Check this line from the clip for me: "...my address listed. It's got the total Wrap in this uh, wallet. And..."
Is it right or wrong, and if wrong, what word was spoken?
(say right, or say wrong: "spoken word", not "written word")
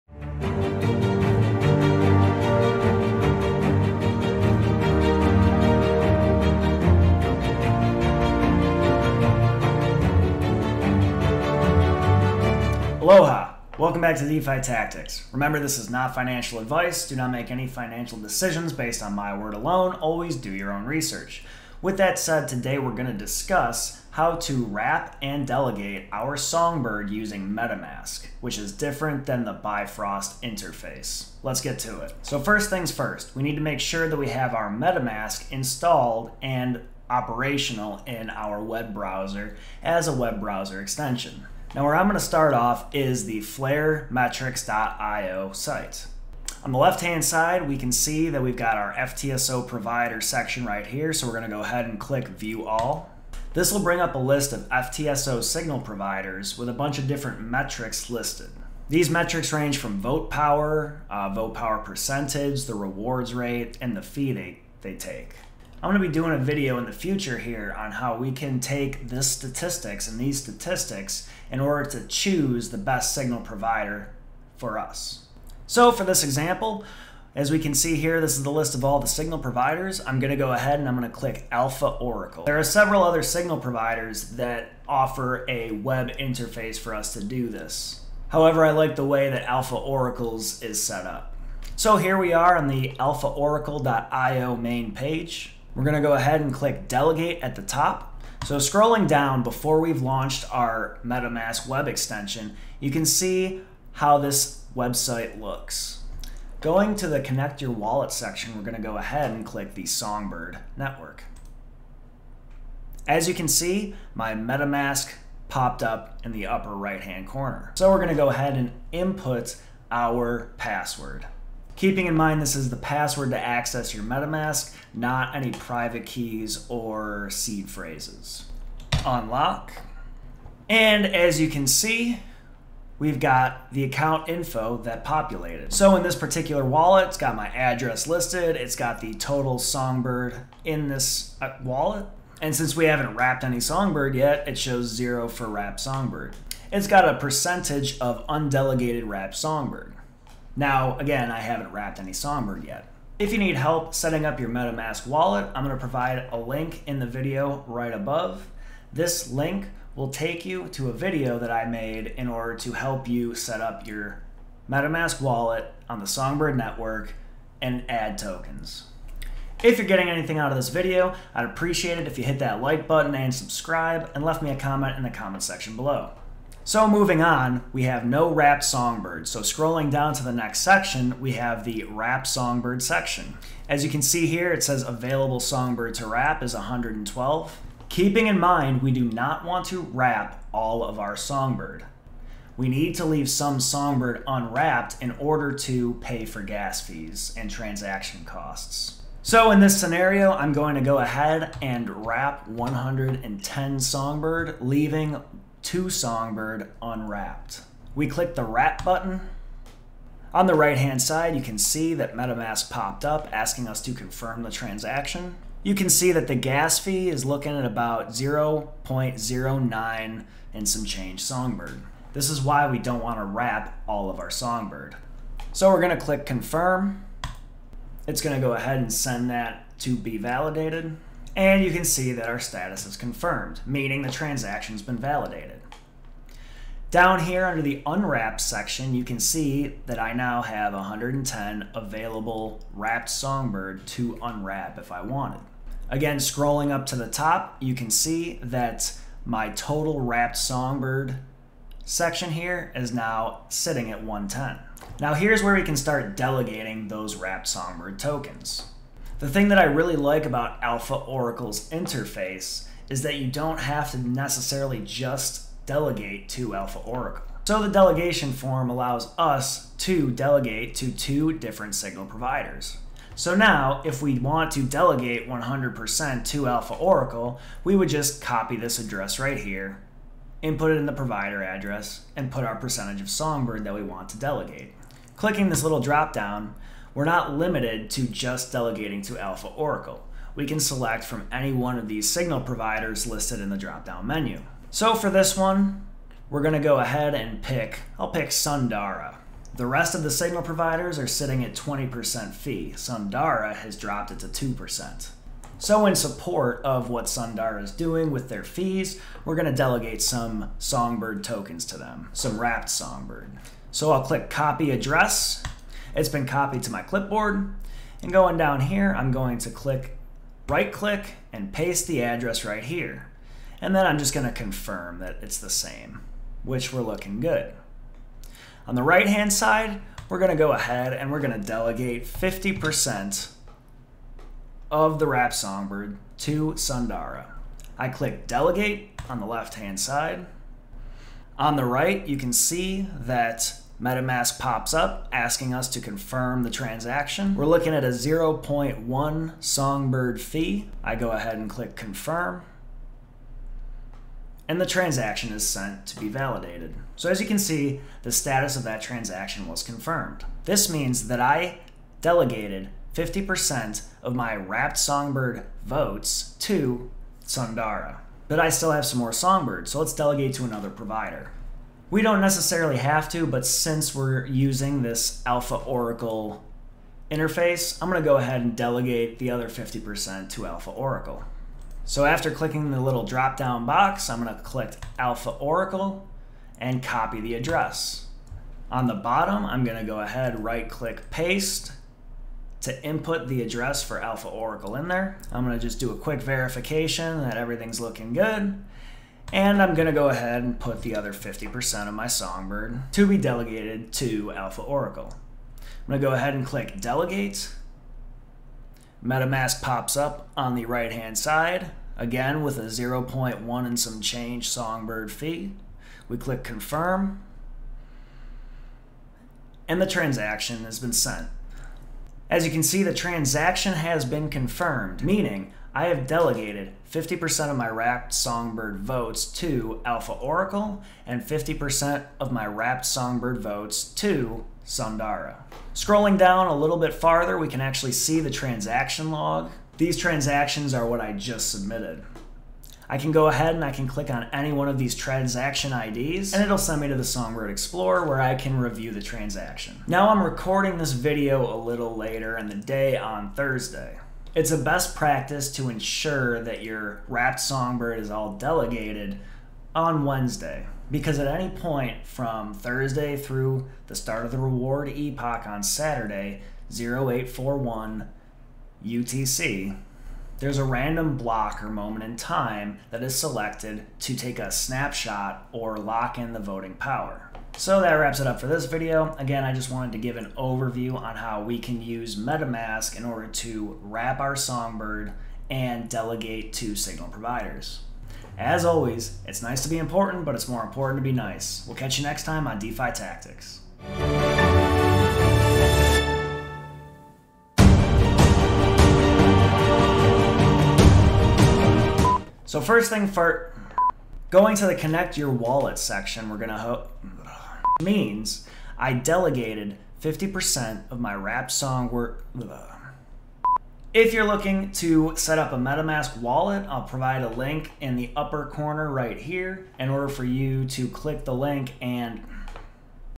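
wrong: "Songbird", not "Wrap".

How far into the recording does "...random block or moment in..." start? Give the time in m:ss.
7:50.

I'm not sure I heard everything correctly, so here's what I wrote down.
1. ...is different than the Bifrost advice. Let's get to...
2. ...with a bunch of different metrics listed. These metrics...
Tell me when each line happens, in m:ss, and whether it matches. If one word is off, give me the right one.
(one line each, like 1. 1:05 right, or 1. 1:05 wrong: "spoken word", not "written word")
1. 0:28 wrong: "interface", not "advice"
2. 0:56 right.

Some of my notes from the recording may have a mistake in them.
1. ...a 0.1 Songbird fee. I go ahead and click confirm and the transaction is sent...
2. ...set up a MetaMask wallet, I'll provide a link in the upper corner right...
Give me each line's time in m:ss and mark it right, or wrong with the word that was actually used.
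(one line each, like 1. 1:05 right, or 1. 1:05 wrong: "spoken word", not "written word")
1. 5:47 right
2. 8:35 right.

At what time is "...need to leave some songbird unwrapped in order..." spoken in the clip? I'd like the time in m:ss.
3:12.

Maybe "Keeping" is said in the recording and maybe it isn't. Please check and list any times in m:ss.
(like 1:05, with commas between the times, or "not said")
2:01, 3:07.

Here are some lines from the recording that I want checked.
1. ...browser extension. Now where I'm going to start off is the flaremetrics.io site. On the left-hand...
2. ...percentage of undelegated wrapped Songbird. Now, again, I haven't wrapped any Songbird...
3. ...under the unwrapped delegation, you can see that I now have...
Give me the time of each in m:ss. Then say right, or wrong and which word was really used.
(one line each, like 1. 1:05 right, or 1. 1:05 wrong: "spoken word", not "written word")
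1. 0:40 right
2. 2:27 right
3. 3:57 wrong: "section", not "delegation".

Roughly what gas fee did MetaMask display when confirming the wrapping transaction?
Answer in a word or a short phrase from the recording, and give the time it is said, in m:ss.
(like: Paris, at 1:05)
0.09 Songbird, at 3:38.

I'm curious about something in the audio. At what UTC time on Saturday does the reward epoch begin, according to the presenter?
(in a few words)
08:41 UTC.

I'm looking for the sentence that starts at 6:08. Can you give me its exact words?
But I still have some more songbirds, so let's delegate to another provider.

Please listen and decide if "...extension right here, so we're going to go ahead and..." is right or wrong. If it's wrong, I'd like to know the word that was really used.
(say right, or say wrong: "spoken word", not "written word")
wrong: "section", not "extension".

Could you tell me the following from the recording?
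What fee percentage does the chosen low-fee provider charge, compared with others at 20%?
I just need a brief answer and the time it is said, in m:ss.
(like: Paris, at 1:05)
2%, at 5:04.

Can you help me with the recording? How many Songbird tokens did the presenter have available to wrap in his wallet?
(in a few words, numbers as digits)
112.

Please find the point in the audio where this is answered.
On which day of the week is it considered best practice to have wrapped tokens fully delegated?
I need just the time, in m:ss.
7:40.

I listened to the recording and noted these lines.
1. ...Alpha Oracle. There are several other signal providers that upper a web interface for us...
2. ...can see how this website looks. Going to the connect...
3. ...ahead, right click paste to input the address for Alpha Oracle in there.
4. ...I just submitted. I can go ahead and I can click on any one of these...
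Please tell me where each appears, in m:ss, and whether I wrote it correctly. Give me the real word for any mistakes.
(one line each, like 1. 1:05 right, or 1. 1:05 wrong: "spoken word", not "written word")
1. 1:21 wrong: "offer", not "upper"
2. 1:42 right
3. 6:29 right
4. 7:20 right.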